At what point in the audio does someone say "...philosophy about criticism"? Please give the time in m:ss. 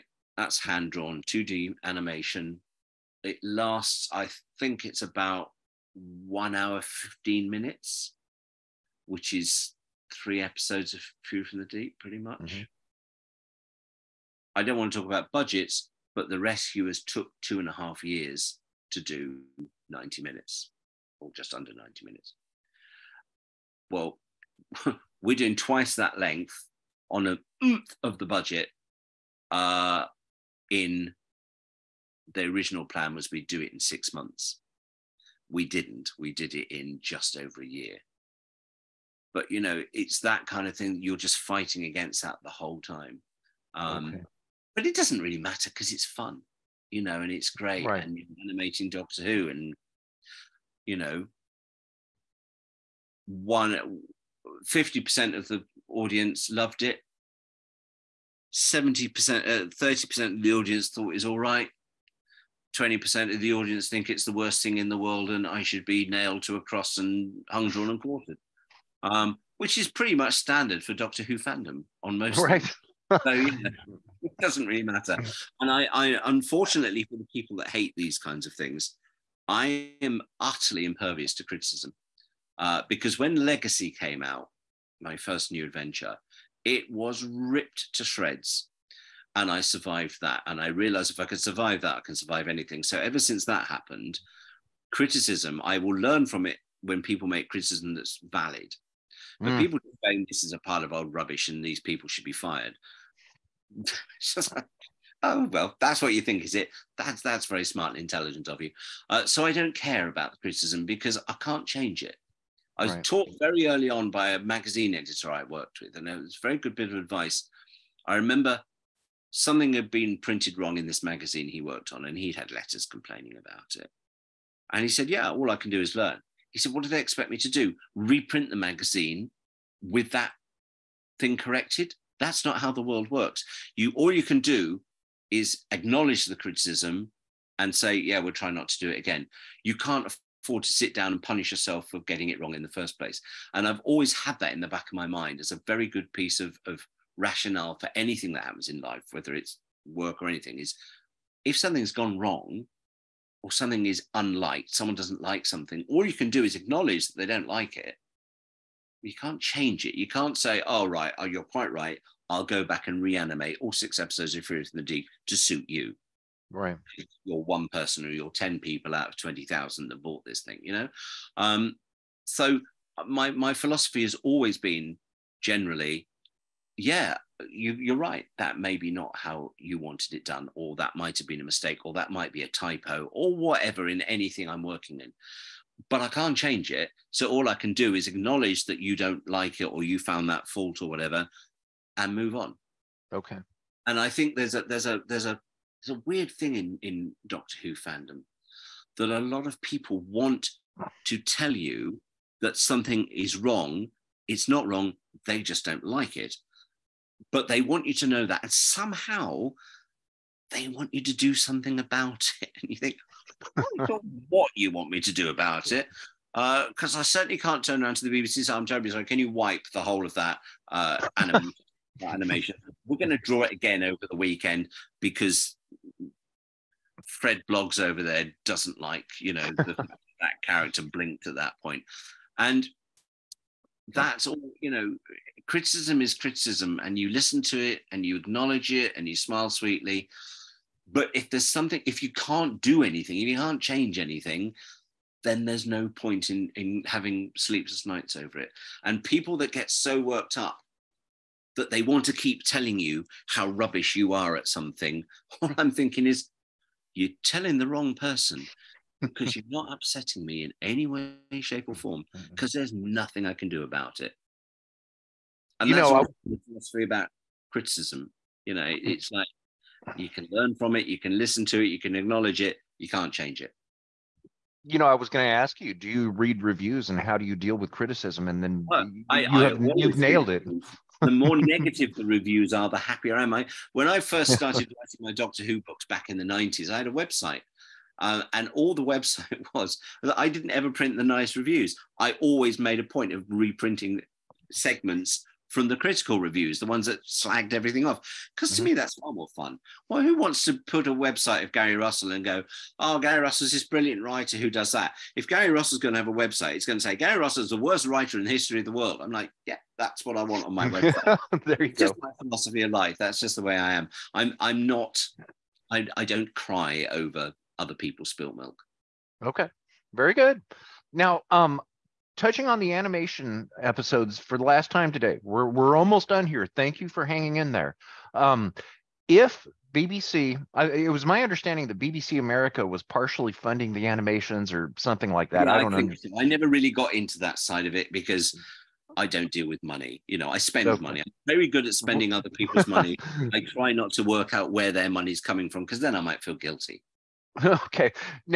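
4:26.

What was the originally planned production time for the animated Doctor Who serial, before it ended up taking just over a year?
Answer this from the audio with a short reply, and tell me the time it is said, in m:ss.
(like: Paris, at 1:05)
6 months, at 0:33.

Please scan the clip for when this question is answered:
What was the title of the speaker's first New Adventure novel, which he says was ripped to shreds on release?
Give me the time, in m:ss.
1:23.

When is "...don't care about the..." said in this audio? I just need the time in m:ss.
1:49.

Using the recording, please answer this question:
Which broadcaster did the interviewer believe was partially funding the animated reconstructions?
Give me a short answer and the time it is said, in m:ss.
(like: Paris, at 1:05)
BBC America, at 5:31.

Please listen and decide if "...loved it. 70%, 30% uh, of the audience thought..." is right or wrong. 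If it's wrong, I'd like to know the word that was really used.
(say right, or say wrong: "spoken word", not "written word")
right.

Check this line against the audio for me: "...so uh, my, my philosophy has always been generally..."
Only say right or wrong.
right.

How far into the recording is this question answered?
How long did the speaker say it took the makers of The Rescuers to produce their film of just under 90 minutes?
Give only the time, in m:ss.
0:17.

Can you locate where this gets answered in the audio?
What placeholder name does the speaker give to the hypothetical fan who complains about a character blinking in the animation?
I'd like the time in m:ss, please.
3:47.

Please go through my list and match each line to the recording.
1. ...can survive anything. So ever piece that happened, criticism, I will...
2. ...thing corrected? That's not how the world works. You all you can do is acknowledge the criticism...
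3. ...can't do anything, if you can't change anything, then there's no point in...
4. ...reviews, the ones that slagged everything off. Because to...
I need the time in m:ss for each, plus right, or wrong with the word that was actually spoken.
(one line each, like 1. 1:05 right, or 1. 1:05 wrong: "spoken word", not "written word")
1. 1:32 wrong: "since", not "piece"
2. 2:11 right
3. 4:02 right
4. 4:56 right.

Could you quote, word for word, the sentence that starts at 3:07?
So all I can do is acknowledge that you don't like it or you found that fault or whatever, and move on.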